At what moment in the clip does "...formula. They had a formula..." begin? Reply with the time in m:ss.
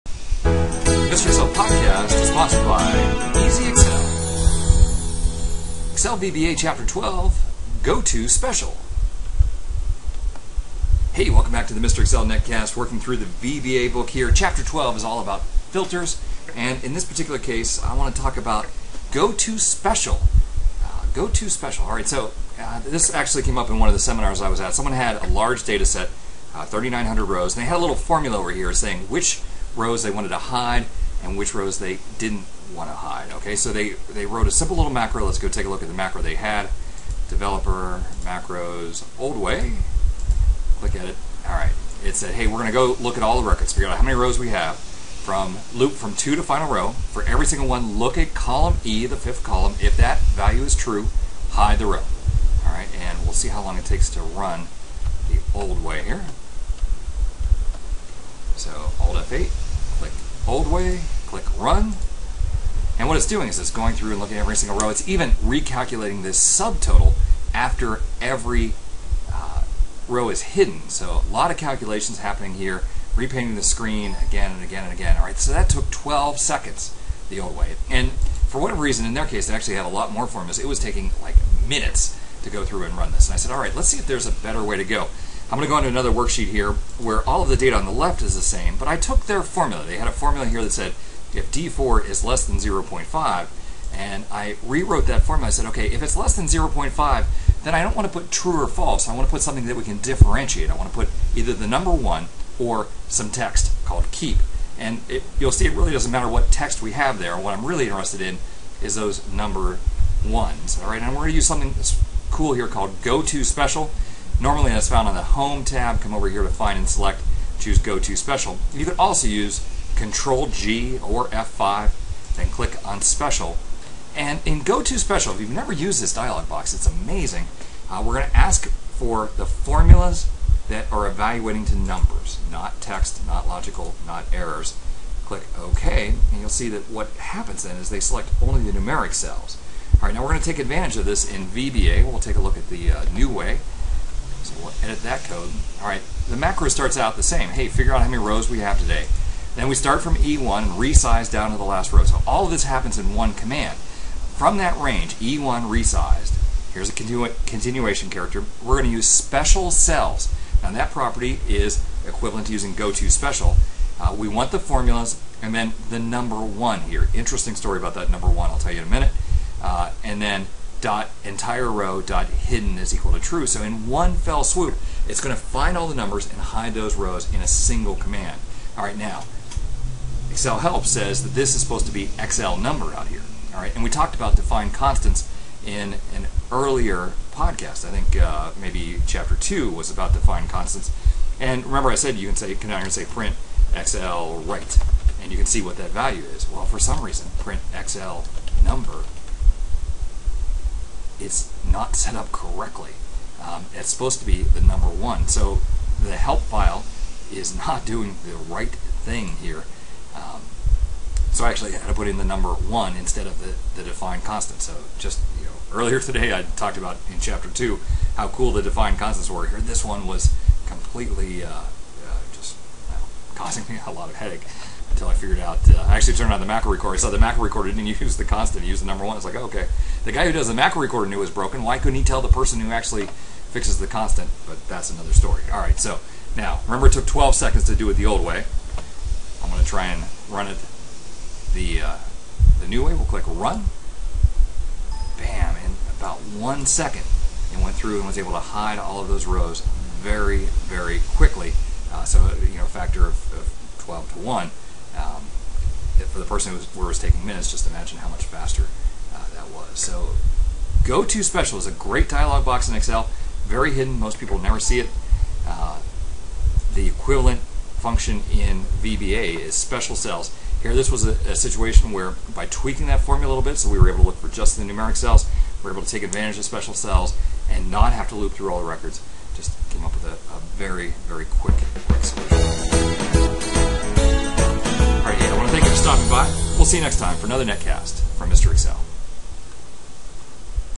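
1:29.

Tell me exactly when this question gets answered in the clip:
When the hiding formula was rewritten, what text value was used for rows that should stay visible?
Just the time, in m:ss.
1:44.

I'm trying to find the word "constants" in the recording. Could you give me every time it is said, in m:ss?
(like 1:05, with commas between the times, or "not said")
3:04, 3:10, 3:34, 3:38, 3:48, 3:53.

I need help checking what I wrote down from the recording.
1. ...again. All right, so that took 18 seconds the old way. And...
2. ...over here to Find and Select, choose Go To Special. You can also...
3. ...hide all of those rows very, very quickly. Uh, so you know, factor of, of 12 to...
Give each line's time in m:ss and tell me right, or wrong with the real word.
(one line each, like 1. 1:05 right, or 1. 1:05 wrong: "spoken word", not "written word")
1. 1:14 wrong: "12", not "18"
2. 1:56 right
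3. 4:08 right.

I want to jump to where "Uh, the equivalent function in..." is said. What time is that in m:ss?
4:25.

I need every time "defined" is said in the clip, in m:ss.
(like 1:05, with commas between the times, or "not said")
3:04, 3:10, 3:33, 3:38.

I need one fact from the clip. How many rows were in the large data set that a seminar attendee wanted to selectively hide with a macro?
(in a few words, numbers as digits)
3,900.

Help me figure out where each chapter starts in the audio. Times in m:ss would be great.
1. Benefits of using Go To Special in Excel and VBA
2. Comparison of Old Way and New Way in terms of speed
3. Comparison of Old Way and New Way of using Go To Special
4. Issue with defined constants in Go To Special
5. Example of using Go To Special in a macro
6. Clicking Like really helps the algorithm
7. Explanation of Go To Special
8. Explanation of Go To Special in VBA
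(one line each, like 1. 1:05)
1. 4:19
2. 3:55
3. 1:15
4. 3:00
5. 0:22
6. 4:41
7. 0:11
8. 2:02.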